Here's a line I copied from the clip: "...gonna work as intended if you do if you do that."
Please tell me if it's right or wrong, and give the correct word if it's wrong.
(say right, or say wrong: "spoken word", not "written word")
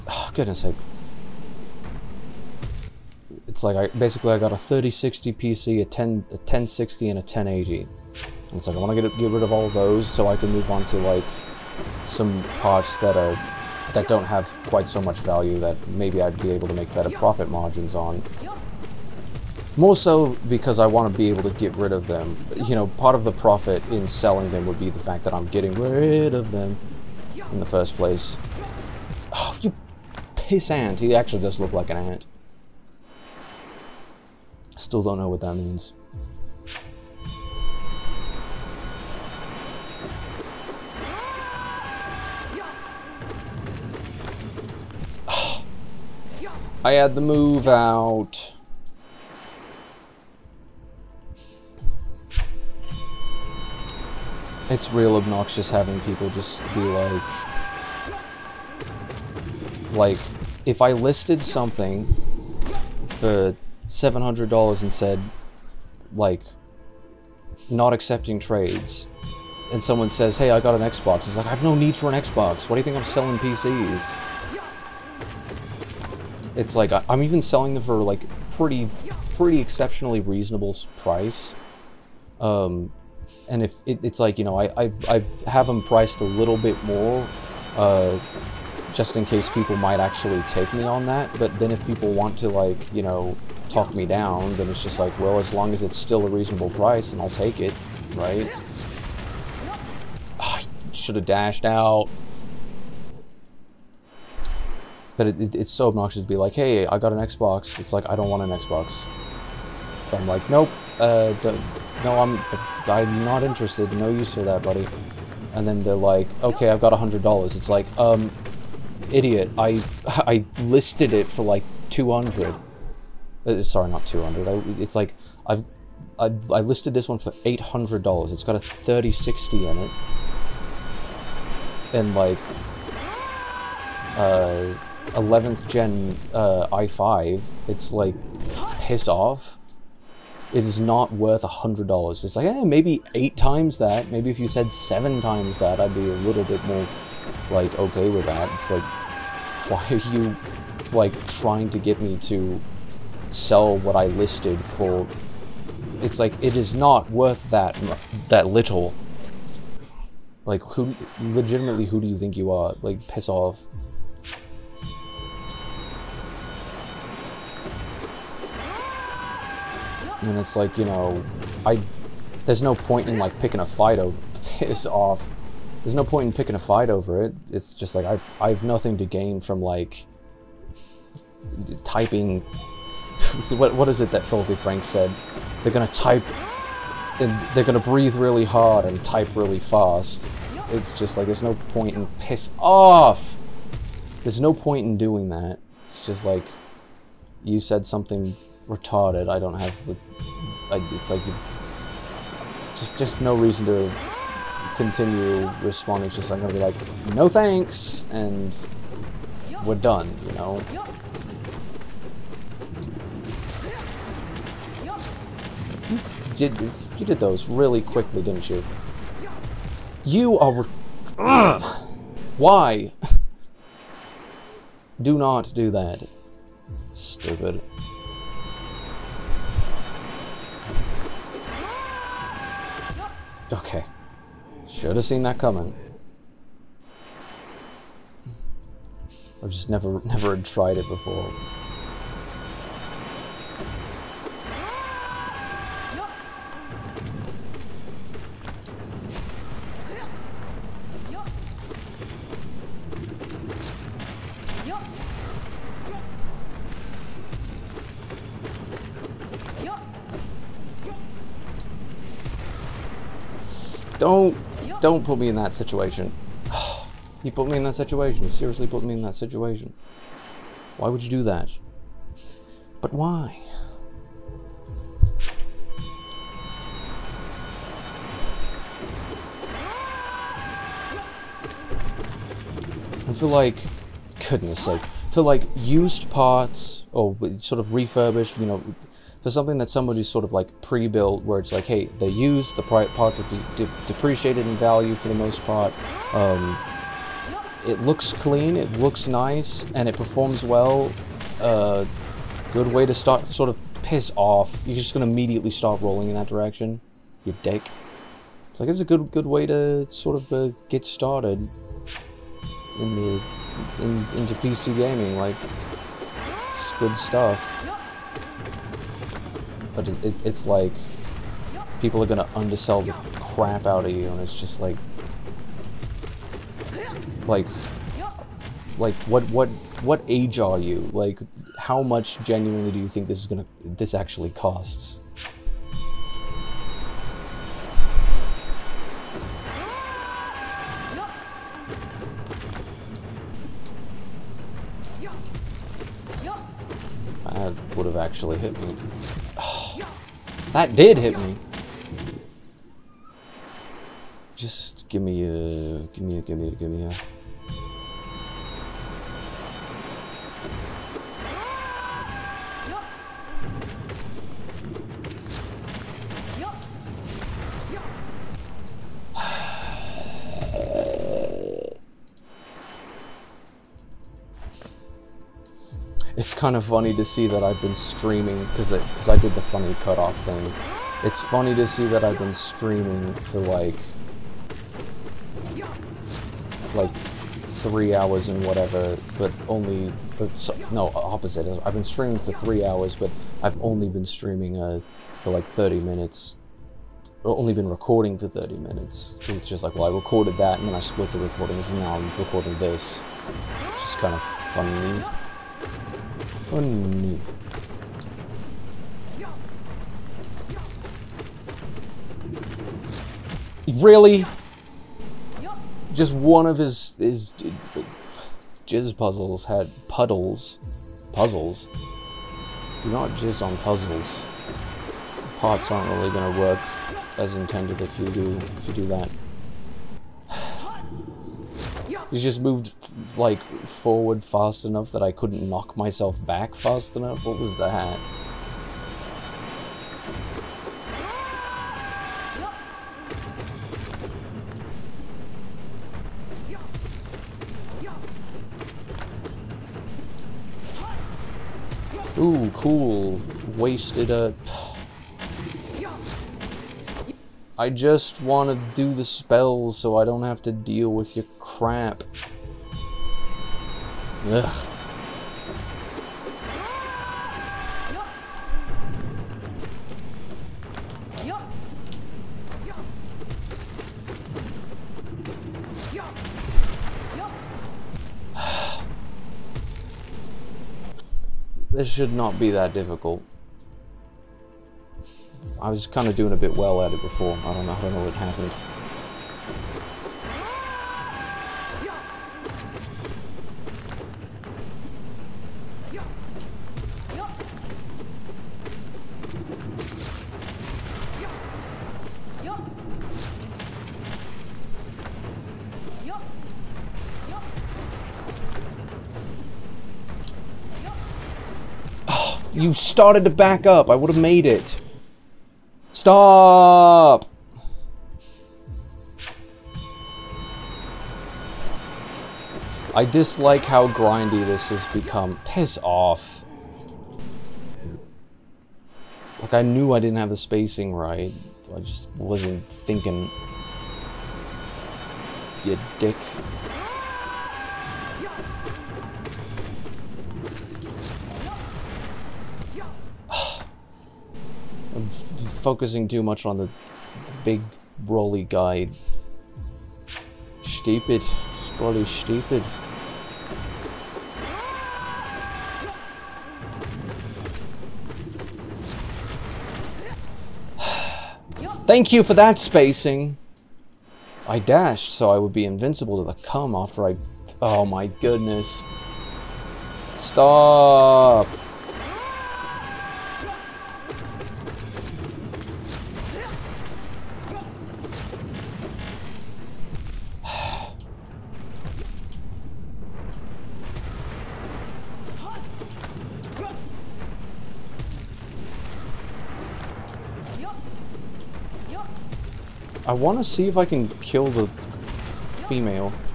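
right.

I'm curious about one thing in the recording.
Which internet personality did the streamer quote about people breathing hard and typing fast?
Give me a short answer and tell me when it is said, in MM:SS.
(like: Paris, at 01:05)
Filthy Frank, at 03:04.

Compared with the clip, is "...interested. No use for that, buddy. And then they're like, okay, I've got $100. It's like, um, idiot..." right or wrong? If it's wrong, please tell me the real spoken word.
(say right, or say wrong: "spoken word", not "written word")
right.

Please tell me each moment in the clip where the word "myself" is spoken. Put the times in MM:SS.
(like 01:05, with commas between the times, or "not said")
07:15.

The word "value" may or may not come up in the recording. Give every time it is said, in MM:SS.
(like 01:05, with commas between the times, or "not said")
00:15, 04:54.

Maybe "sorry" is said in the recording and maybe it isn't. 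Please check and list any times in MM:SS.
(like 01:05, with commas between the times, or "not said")
02:03.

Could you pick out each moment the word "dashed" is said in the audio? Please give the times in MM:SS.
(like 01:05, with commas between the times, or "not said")
01:41, 09:24.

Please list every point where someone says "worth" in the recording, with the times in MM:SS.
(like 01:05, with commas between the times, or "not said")
02:21, 02:37.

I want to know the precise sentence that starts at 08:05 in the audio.
I was kind of doing a bit well at it before.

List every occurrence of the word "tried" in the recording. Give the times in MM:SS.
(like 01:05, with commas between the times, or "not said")
04:00.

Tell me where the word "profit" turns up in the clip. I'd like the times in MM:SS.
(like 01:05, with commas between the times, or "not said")
00:17, 00:23.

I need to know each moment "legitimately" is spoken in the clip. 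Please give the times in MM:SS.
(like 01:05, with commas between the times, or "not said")
02:41.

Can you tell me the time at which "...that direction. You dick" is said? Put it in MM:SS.
05:06.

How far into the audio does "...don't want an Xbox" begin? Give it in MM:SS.
01:48.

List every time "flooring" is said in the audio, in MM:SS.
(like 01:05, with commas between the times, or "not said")
not said.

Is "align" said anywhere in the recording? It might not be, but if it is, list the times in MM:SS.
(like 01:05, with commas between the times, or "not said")
not said.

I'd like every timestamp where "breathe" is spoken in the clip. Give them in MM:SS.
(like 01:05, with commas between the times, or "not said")
03:07.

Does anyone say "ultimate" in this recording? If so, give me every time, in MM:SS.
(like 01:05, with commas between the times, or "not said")
not said.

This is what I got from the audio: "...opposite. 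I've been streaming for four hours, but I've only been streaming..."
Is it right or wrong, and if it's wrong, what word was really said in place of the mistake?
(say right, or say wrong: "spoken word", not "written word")
wrong: "three", not "four".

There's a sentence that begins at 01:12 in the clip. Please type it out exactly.
Why do you think I'm selling PCs?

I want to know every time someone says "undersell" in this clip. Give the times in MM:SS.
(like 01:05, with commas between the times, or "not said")
05:22.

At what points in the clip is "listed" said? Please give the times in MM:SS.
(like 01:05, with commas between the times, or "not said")
01:00, 02:00, 02:06, 02:34.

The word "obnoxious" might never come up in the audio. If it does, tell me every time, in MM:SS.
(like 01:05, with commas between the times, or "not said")
00:55, 01:45.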